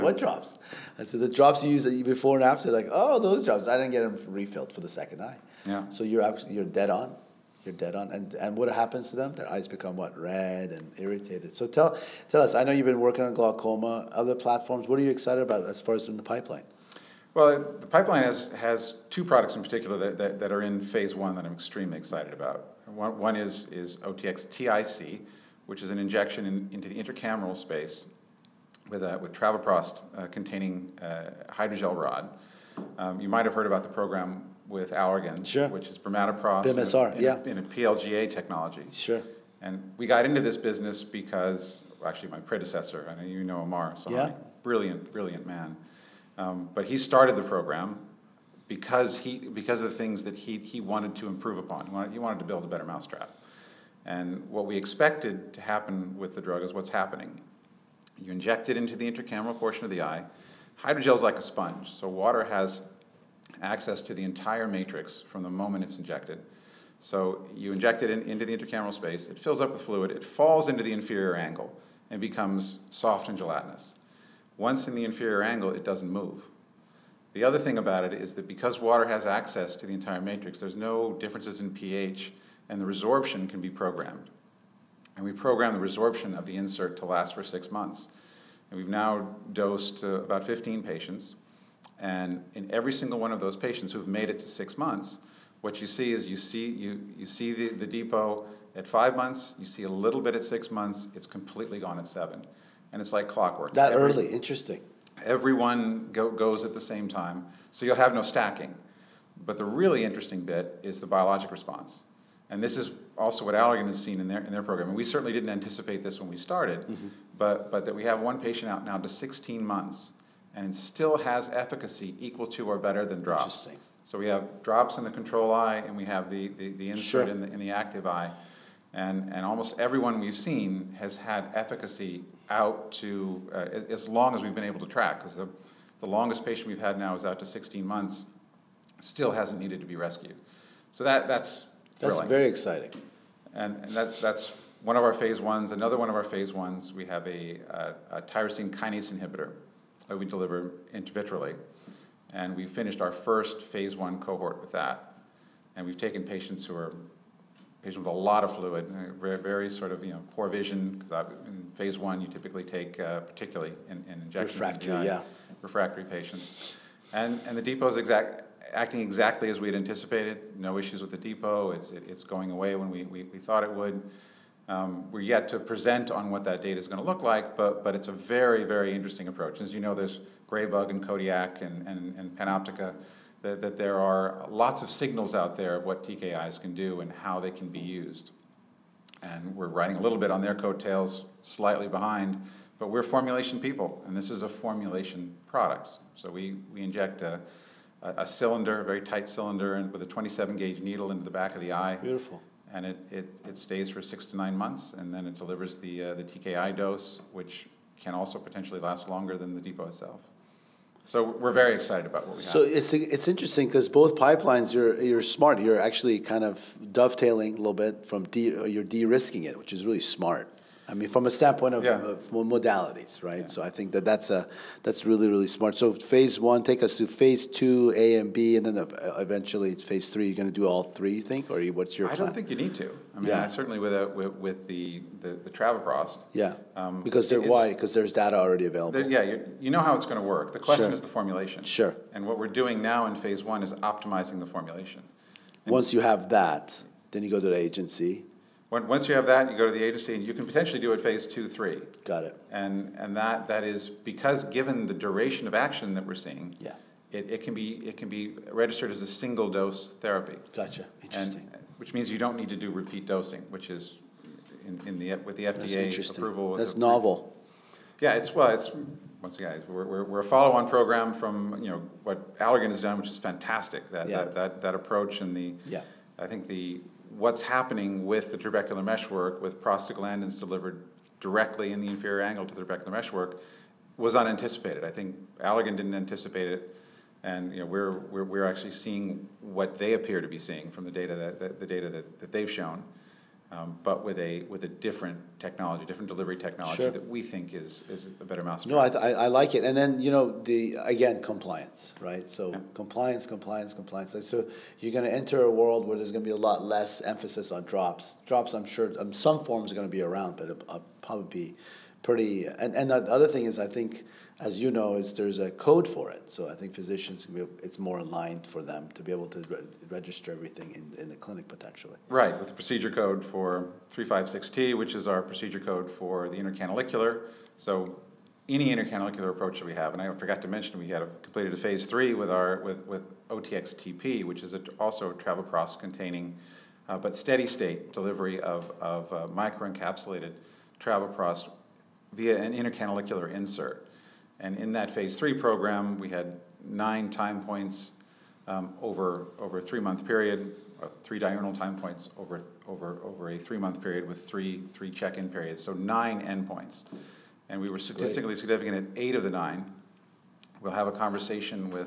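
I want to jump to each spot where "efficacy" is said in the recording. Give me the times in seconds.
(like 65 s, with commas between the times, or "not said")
121 s, 131 s.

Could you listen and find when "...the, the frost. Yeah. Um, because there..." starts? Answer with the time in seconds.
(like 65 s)
235 s.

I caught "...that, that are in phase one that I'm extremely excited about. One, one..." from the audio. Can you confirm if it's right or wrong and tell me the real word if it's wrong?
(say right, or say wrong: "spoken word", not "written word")
right.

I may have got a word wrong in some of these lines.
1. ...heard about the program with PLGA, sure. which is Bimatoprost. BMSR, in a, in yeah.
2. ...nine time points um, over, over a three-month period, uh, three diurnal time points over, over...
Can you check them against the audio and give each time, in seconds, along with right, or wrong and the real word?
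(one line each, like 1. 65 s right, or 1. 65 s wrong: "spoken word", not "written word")
1. 33 s wrong: "Allergan", not "PLGA"
2. 346 s right.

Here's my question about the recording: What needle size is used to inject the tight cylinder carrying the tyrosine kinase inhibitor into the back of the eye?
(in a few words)
27 gauge.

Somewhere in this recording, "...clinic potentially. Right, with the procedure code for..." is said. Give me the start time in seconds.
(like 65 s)
321 s.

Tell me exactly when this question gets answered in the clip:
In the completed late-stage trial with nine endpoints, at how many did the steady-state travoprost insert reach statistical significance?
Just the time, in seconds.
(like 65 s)
359 s.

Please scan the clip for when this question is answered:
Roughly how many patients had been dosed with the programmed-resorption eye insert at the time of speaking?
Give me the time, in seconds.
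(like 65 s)
90 s.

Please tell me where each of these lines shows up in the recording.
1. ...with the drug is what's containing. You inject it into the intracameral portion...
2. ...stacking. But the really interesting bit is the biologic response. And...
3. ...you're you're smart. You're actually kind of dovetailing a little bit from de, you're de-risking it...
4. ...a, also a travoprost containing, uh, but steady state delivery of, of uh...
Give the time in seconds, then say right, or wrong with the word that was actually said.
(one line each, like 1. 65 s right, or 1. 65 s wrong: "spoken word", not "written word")
1. 56 s wrong: "happening", not "containing"
2. 108 s right
3. 214 s right
4. 334 s right.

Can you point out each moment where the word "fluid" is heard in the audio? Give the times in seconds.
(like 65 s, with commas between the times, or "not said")
69 s, 158 s.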